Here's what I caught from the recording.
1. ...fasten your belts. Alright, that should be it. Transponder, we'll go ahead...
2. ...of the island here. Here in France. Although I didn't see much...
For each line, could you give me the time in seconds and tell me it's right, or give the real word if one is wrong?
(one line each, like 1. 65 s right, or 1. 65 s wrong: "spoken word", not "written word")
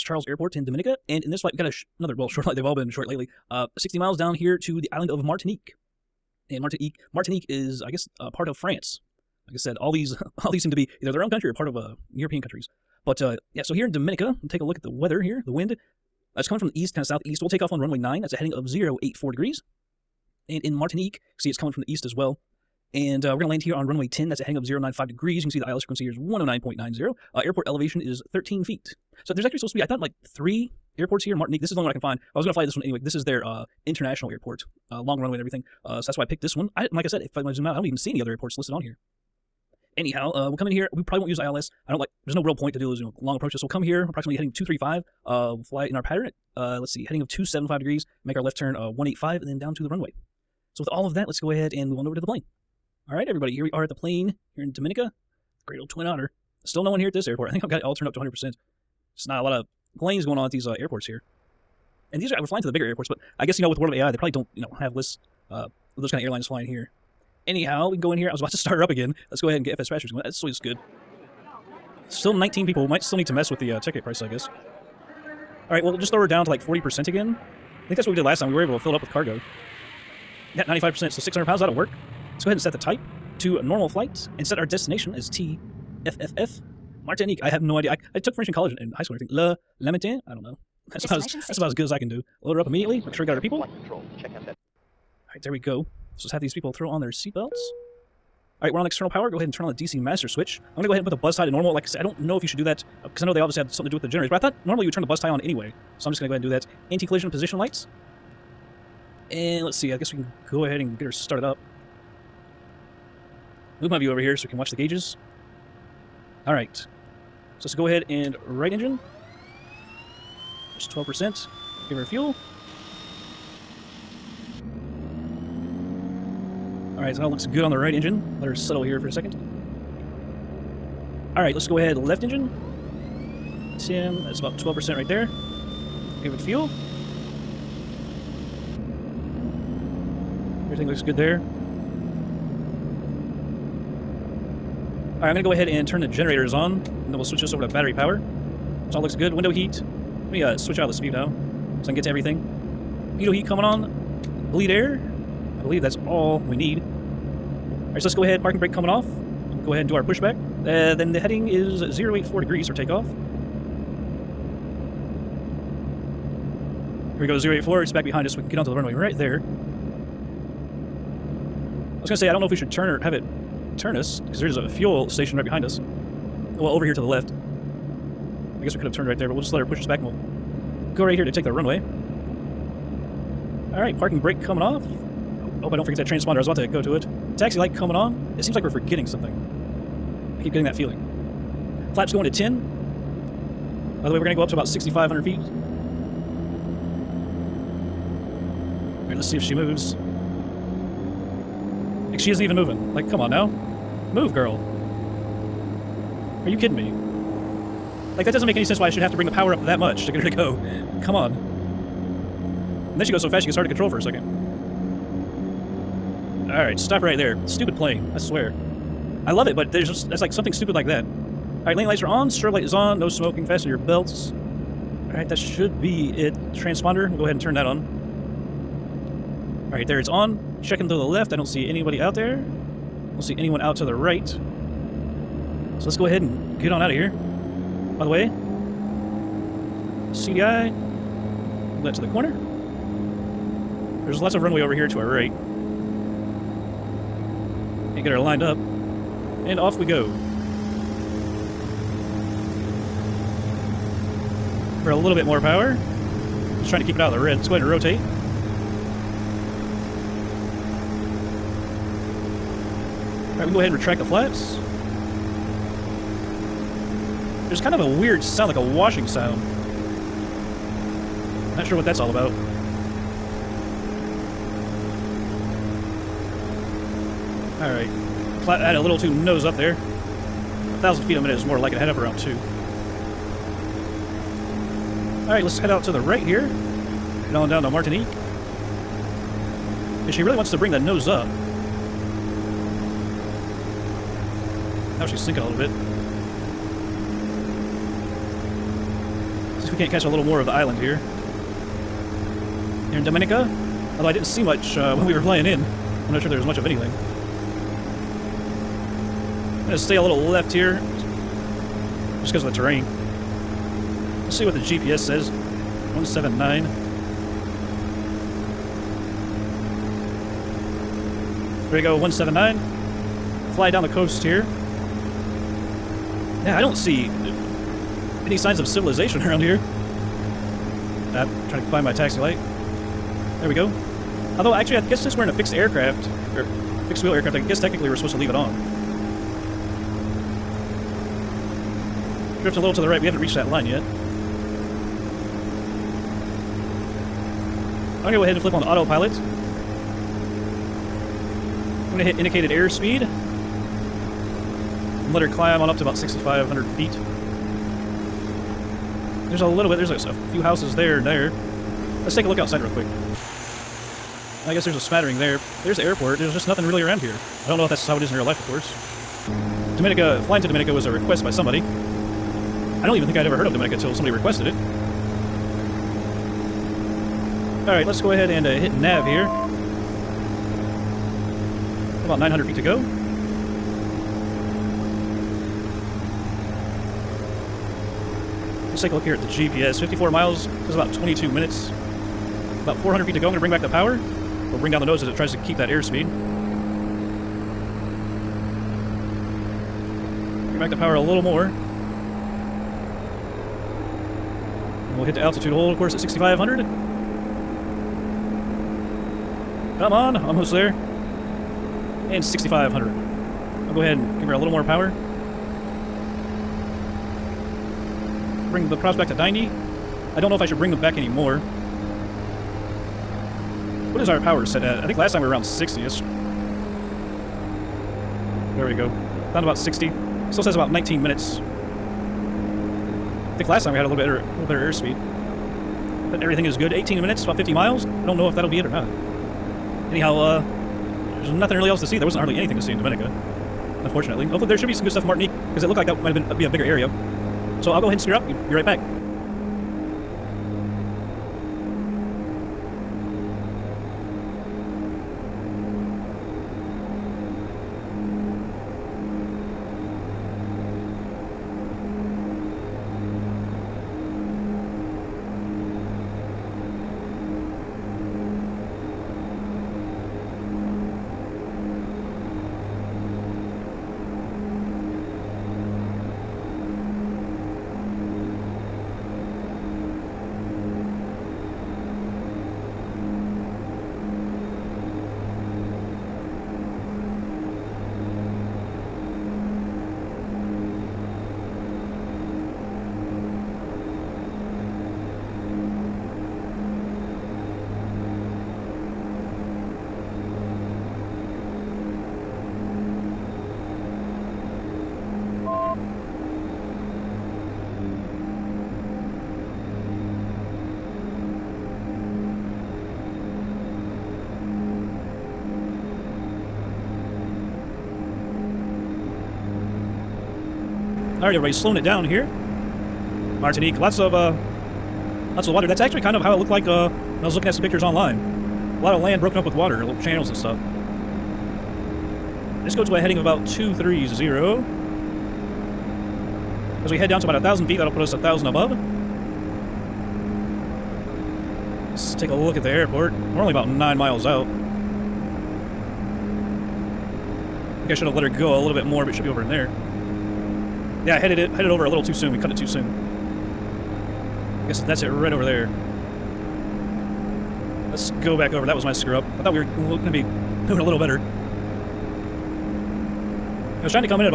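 1. 223 s right
2. 300 s wrong: "Dominica", not "France".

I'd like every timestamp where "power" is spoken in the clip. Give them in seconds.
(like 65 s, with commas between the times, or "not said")
99 s, 147 s, 209 s, 255 s, 393 s, 400 s, 414 s, 424 s.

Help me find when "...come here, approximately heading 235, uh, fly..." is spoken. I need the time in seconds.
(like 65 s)
43 s.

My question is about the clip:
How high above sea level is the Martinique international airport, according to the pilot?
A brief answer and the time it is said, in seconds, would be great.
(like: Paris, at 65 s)
13 feet, at 28 s.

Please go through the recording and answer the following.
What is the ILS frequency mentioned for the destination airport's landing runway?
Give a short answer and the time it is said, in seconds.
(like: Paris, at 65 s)
109.90, at 26 s.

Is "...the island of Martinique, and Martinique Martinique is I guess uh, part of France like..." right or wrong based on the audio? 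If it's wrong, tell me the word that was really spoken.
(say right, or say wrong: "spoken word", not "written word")
right.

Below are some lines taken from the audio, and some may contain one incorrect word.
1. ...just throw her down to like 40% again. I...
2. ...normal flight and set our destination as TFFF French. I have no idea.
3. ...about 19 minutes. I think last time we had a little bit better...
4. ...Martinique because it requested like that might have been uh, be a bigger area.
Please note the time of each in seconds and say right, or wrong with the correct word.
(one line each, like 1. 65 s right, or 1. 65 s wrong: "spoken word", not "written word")
1. 75 s right
2. 83 s wrong: "Martinique", not "French"
3. 430 s right
4. 445 s wrong: "looked", not "requested".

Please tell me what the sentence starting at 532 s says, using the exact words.
Let's go to a heading of about 230.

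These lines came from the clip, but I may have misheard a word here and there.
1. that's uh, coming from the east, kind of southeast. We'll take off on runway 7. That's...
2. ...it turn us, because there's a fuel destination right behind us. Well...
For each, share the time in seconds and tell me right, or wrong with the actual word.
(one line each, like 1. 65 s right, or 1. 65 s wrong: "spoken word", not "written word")
1. 16 s wrong: "9", not "7"
2. 173 s wrong: "station", not "destination".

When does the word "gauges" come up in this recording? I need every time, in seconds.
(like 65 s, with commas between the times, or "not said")
114 s.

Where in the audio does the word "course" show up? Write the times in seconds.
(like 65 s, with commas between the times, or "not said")
368 s, 405 s.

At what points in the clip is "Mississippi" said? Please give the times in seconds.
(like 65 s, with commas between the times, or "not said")
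not said.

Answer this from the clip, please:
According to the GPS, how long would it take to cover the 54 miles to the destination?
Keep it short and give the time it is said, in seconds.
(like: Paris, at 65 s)
22 minutes, at 390 s.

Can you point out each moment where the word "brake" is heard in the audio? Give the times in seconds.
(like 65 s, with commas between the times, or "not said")
158 s, 184 s.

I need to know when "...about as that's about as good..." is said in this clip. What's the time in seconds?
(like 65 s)
91 s.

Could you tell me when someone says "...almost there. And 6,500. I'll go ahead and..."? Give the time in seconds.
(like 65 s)
410 s.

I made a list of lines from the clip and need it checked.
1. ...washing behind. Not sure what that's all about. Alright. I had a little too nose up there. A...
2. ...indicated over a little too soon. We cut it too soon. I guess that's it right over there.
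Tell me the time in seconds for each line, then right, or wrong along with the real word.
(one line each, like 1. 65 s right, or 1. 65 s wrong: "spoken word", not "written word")
1. 268 s wrong: "sound", not "behind"
2. 551 s wrong: "headed", not "indicated".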